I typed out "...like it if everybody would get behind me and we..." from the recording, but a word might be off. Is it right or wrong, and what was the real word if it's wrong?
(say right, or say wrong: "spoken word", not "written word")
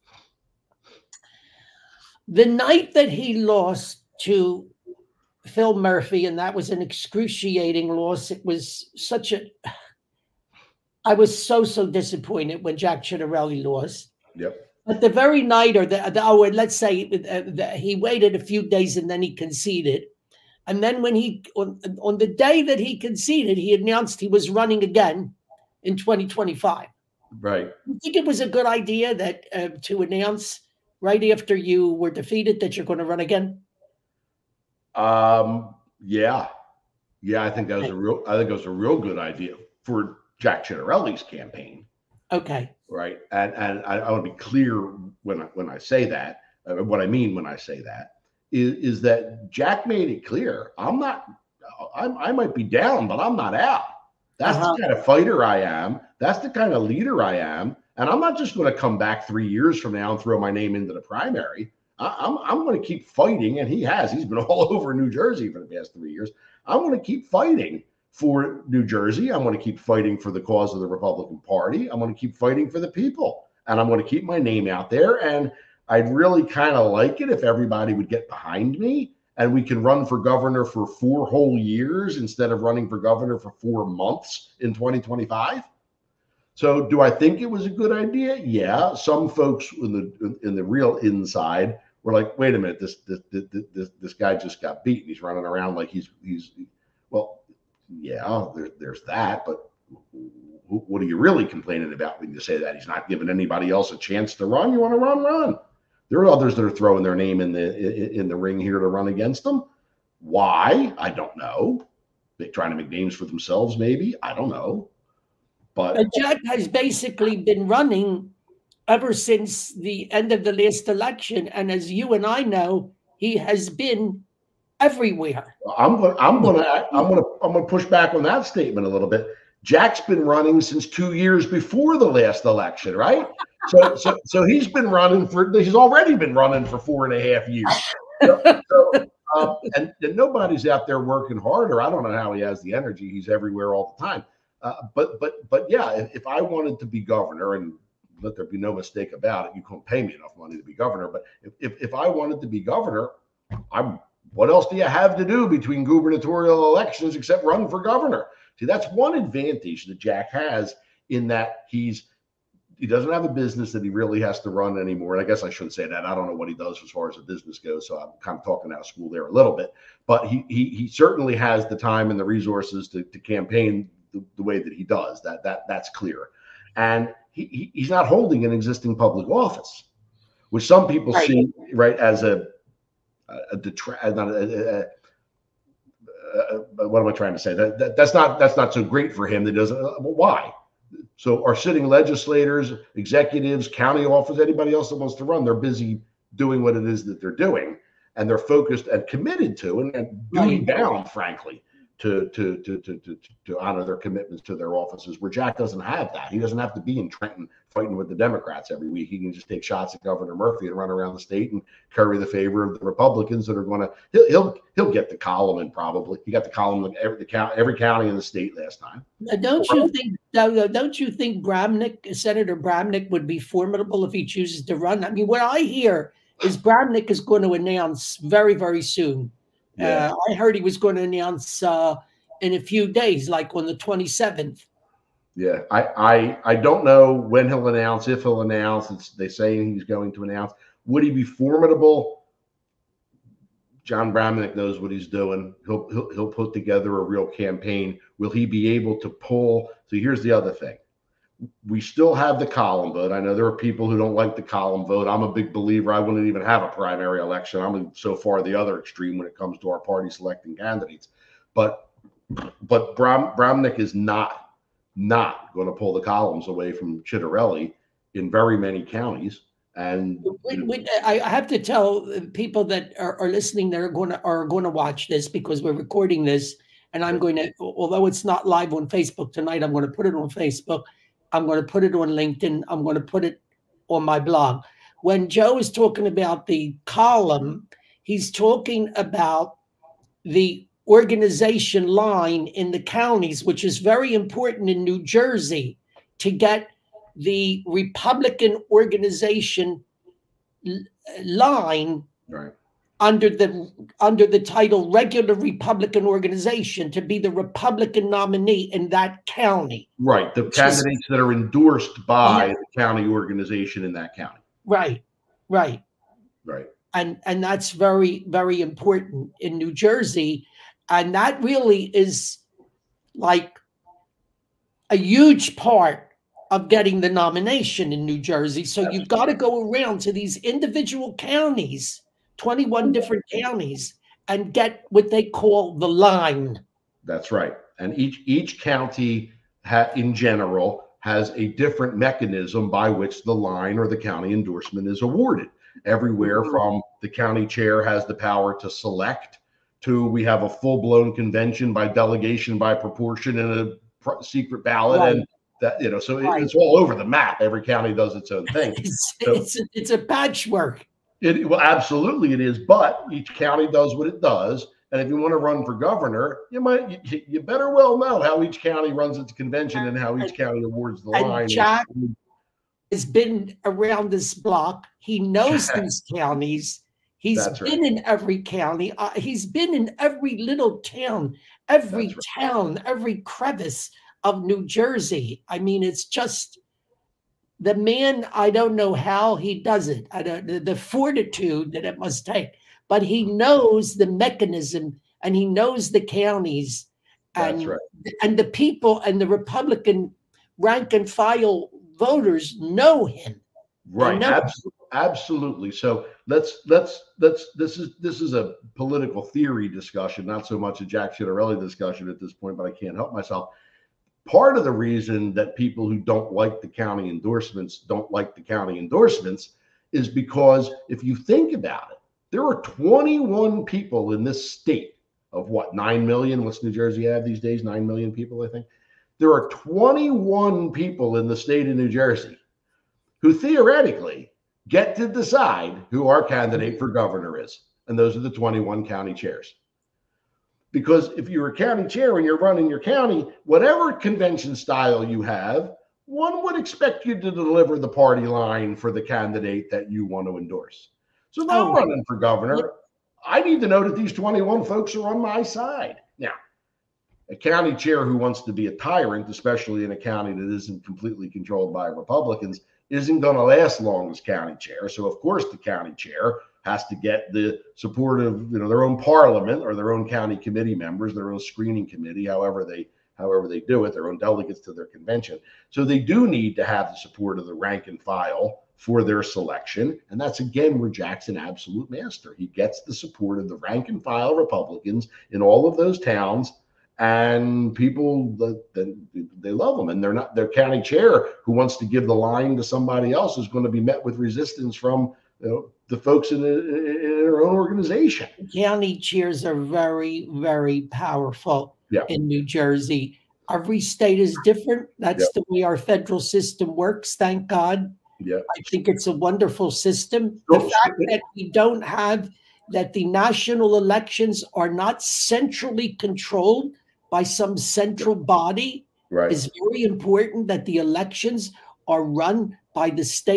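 right.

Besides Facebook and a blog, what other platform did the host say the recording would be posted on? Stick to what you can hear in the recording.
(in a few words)
LinkedIn.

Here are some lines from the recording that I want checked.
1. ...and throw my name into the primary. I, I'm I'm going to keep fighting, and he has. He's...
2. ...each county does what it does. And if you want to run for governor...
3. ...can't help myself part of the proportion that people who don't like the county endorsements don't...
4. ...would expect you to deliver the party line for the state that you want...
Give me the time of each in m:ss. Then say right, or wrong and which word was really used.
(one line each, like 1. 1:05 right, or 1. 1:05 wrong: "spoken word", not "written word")
1. 1:00 right
2. 6:03 right
3. 6:52 wrong: "reason", not "proportion"
4. 7:26 wrong: "candidate", not "state".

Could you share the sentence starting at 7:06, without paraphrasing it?
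What's New Jersey have these days?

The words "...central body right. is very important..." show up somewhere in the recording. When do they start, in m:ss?
8:37.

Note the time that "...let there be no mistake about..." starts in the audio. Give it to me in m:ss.
2:28.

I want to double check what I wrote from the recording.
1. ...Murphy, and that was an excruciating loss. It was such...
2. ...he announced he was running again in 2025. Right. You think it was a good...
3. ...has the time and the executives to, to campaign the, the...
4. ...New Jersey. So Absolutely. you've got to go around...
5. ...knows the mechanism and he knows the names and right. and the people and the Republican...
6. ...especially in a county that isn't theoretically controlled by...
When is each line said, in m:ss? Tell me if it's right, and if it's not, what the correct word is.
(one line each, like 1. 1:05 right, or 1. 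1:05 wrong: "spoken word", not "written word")
1. 0:05 right
2. 0:23 right
3. 2:51 wrong: "resources", not "executives"
4. 5:28 right
5. 6:33 wrong: "counties", not "names"
6. 7:39 wrong: "completely", not "theoretically".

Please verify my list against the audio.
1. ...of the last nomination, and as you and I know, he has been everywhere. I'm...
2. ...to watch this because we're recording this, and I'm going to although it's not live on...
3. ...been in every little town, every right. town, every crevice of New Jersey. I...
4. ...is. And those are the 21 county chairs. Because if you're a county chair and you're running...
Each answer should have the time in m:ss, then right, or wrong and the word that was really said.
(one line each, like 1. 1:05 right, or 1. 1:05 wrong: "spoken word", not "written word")
1. 2:00 wrong: "election", not "nomination"
2. 4:34 right
3. 6:19 right
4. 7:17 right.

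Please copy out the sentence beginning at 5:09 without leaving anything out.
Right, the candidates that are endorsed by yeah.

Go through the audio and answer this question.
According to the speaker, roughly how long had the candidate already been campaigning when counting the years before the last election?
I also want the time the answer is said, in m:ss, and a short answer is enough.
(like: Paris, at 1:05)
four and a half years, at 2:16.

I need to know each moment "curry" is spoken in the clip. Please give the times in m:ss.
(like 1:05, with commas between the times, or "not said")
3:31.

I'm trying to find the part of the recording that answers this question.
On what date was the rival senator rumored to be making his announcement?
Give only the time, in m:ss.
3:53.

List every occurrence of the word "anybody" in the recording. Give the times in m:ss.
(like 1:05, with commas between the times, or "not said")
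1:43, 3:14.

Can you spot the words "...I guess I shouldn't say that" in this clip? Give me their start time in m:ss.
2:45.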